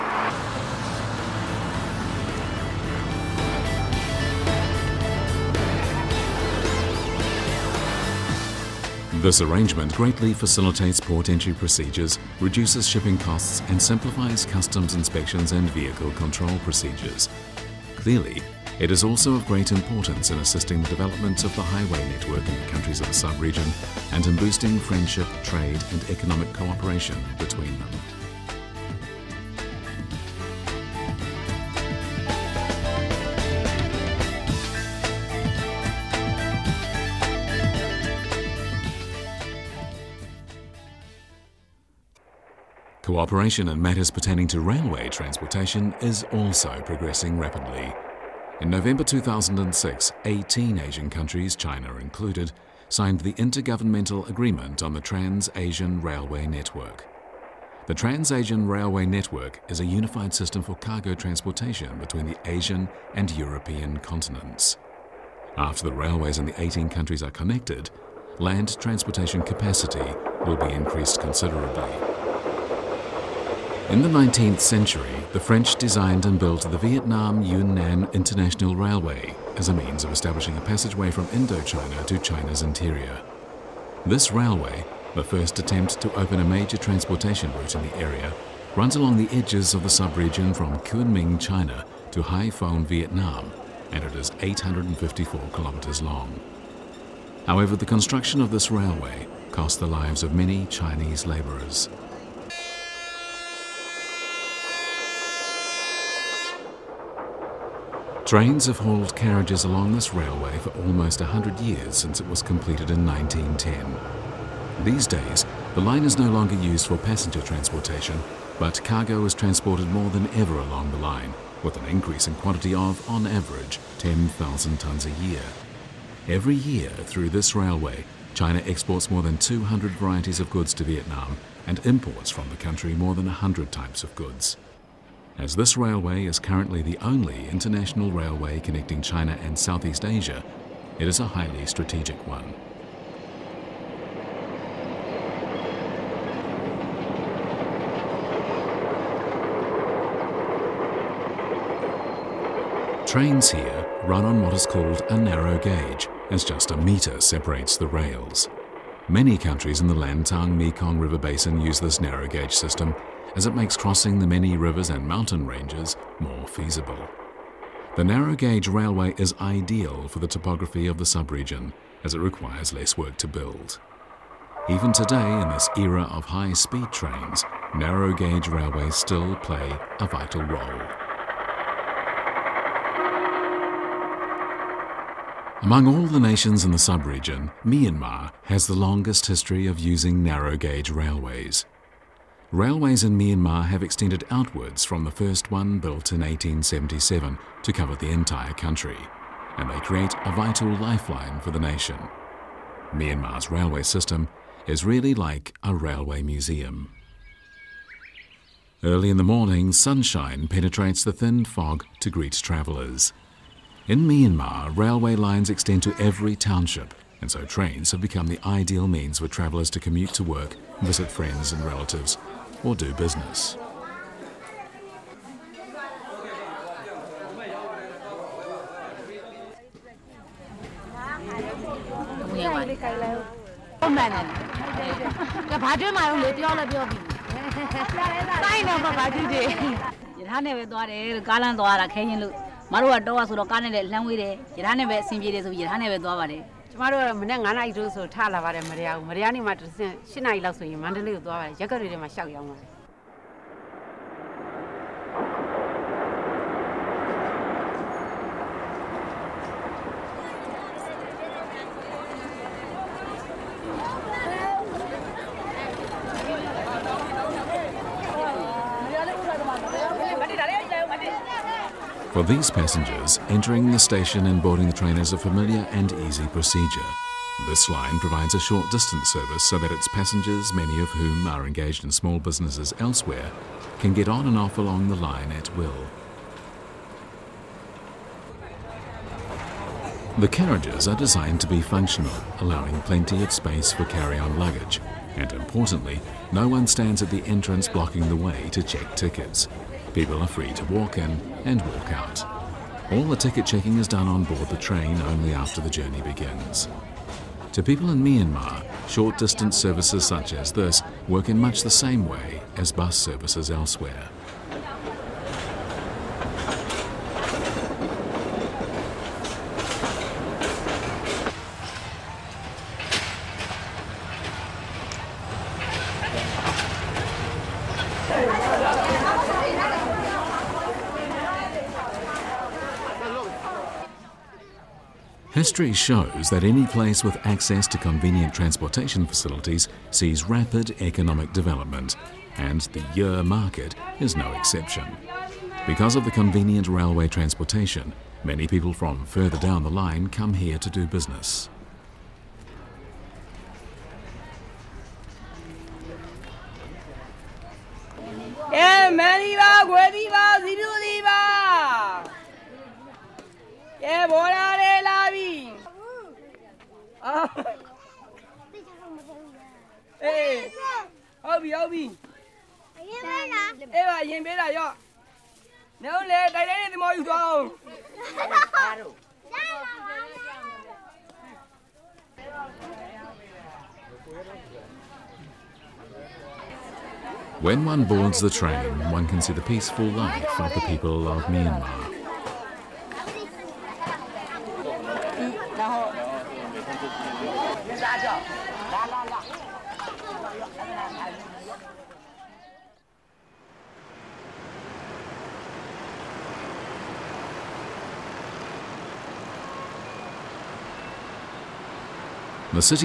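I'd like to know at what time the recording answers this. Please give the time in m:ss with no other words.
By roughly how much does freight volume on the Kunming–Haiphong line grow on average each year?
2:03.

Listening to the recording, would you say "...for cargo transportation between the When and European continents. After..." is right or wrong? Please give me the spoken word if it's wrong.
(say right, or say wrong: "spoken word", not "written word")
wrong: "Asian", not "When".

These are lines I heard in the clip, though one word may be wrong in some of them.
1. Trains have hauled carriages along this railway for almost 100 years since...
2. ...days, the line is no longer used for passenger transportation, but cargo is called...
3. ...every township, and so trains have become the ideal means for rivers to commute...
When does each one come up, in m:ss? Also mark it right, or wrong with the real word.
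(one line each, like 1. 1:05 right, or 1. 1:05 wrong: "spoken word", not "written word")
1. 1:48 right
2. 1:55 wrong: "transported", not "called"
3. 3:35 wrong: "travellers", not "rivers".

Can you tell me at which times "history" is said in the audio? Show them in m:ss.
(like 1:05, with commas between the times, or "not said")
3:09, 5:35.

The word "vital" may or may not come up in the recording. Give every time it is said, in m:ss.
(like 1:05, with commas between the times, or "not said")
3:00, 3:20.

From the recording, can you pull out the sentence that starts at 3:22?
Myanmar's railway system is really like a railway museum.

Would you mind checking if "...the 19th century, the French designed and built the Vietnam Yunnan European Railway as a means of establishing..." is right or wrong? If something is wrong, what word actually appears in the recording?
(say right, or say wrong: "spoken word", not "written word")
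wrong: "International", not "European".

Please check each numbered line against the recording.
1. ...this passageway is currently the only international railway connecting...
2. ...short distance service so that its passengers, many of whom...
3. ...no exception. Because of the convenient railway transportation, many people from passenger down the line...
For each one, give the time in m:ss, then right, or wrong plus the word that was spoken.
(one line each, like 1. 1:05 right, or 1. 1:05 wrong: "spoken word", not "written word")
1. 2:15 wrong: "railway", not "passageway"
2. 4:38 right
3. 5:44 wrong: "further", not "passenger".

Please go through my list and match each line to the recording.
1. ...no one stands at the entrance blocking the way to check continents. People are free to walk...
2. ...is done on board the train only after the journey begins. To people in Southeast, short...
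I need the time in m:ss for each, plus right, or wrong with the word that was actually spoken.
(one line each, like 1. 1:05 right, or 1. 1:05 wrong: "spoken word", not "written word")
1. 4:56 wrong: "tickets", not "continents"
2. 5:03 wrong: "Myanmar", not "Southeast".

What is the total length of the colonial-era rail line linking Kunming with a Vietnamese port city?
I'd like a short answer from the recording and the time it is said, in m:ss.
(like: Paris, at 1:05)
854 kilometers, at 1:34.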